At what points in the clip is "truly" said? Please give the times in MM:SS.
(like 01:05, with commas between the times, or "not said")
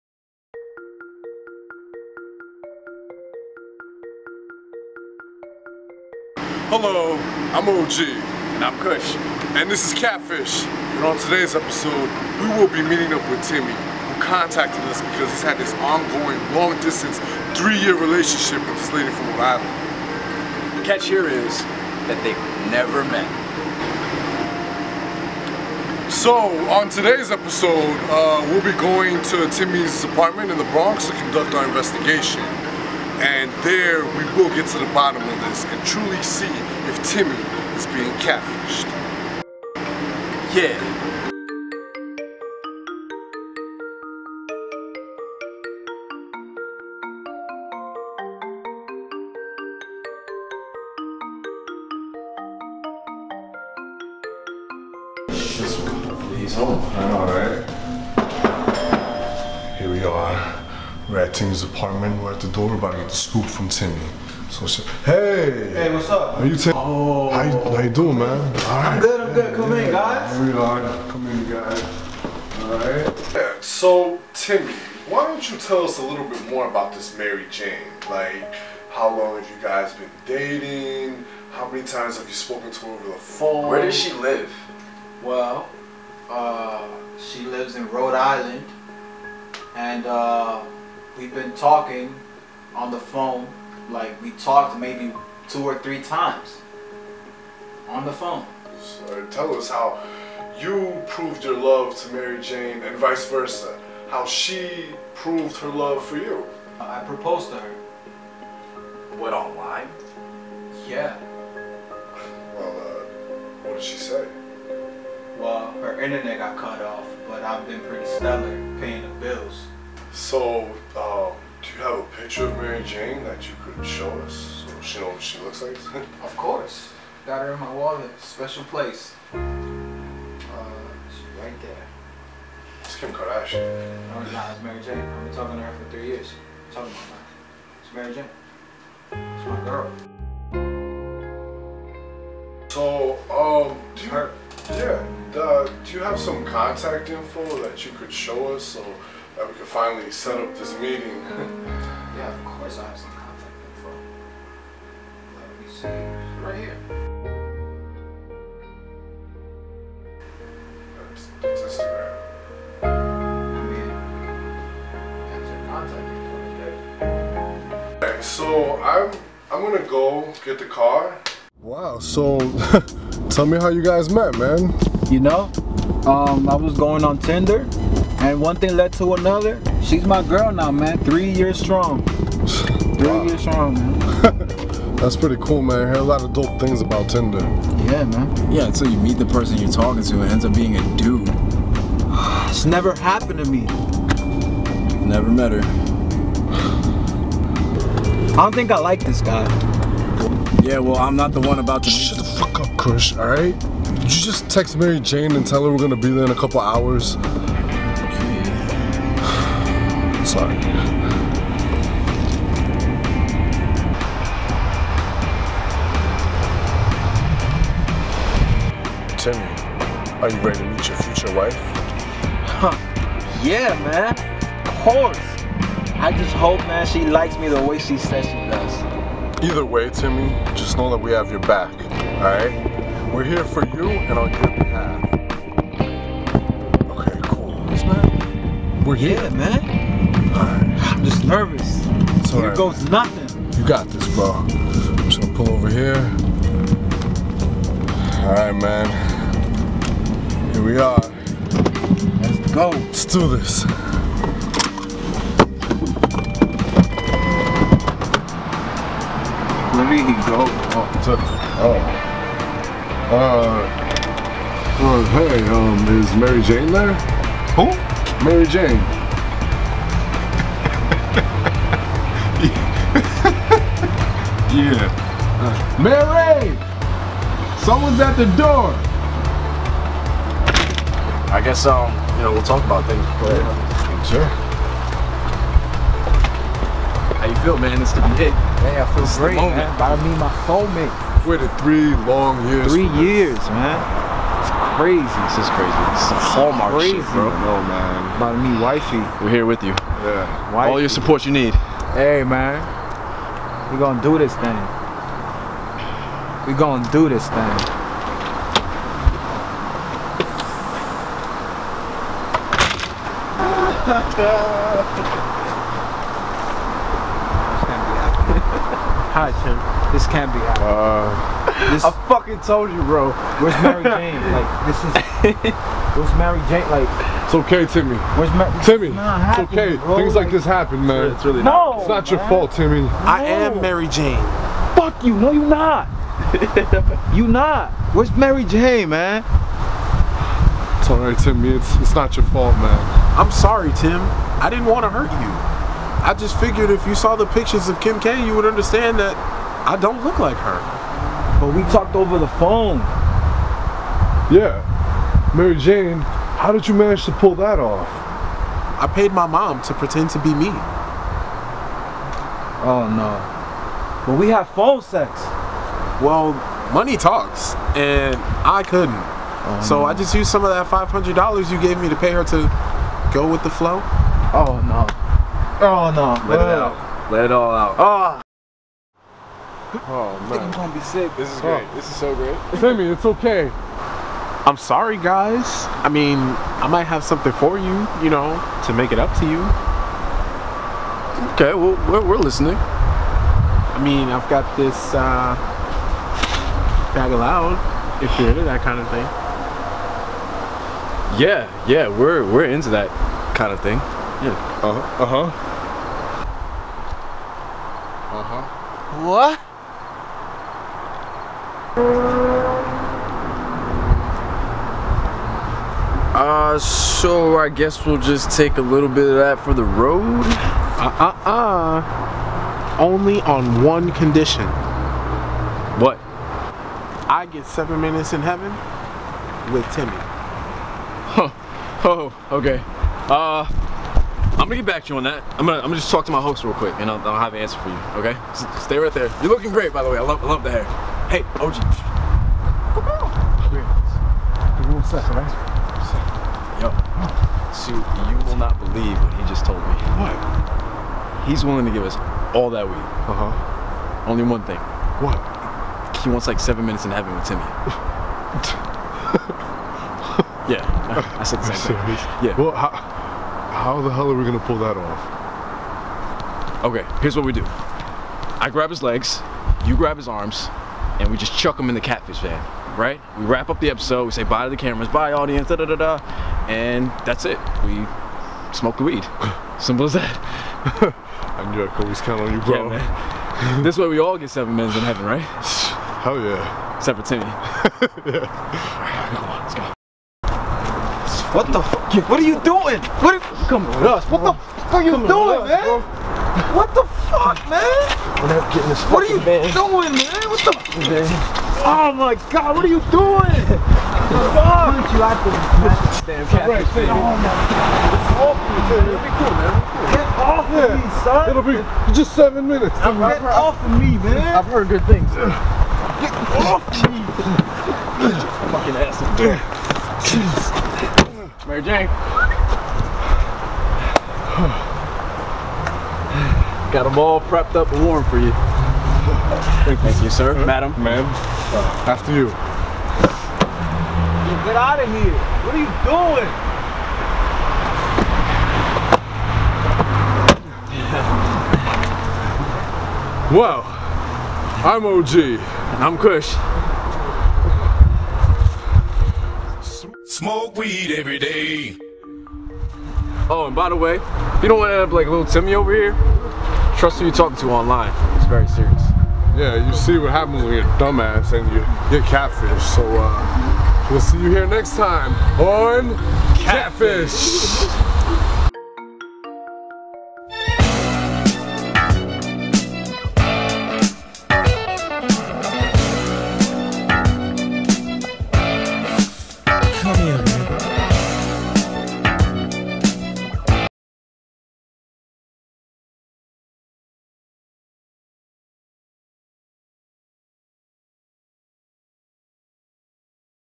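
00:35.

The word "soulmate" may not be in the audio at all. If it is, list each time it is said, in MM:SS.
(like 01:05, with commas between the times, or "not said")
04:50.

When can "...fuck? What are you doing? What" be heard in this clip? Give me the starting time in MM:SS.
08:11.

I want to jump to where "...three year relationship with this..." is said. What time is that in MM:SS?
00:17.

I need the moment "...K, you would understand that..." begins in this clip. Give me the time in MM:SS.
05:48.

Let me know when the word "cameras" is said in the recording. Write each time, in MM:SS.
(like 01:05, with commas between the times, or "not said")
07:54.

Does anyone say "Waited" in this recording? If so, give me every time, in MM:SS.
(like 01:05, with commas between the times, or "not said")
04:51.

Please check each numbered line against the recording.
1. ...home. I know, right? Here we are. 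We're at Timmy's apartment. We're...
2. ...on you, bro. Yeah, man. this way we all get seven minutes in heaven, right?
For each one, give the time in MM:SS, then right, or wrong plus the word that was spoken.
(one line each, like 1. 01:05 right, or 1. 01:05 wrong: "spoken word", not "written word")
1. 00:56 right
2. 08:02 right.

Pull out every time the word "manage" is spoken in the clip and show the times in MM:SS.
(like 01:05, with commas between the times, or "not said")
05:56.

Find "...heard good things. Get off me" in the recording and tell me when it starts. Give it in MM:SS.
08:34.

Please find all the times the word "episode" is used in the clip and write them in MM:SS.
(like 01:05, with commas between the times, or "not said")
00:11, 00:27, 07:53.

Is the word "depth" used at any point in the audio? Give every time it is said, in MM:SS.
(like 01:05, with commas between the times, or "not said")
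not said.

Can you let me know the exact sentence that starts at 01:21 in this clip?
How many times have you spoken to her over the phone?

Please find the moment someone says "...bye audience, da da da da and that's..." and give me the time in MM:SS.
07:54.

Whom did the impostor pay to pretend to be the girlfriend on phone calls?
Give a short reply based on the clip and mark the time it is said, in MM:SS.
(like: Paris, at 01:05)
my mom, at 05:59.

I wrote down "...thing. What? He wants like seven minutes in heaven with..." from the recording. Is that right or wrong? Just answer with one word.
right.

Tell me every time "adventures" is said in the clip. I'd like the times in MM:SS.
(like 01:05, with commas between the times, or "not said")
not said.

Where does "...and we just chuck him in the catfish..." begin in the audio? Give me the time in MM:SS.
07:50.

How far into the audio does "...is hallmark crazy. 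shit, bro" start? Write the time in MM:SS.
04:56.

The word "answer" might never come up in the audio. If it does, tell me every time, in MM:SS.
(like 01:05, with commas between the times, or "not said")
07:17.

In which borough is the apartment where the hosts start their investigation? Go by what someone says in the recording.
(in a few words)
the Bronx.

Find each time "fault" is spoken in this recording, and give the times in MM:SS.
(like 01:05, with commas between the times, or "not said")
05:32, 05:42.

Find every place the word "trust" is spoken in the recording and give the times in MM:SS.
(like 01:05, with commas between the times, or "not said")
09:16.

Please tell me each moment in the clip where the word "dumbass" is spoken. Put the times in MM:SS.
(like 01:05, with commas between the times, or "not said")
09:20.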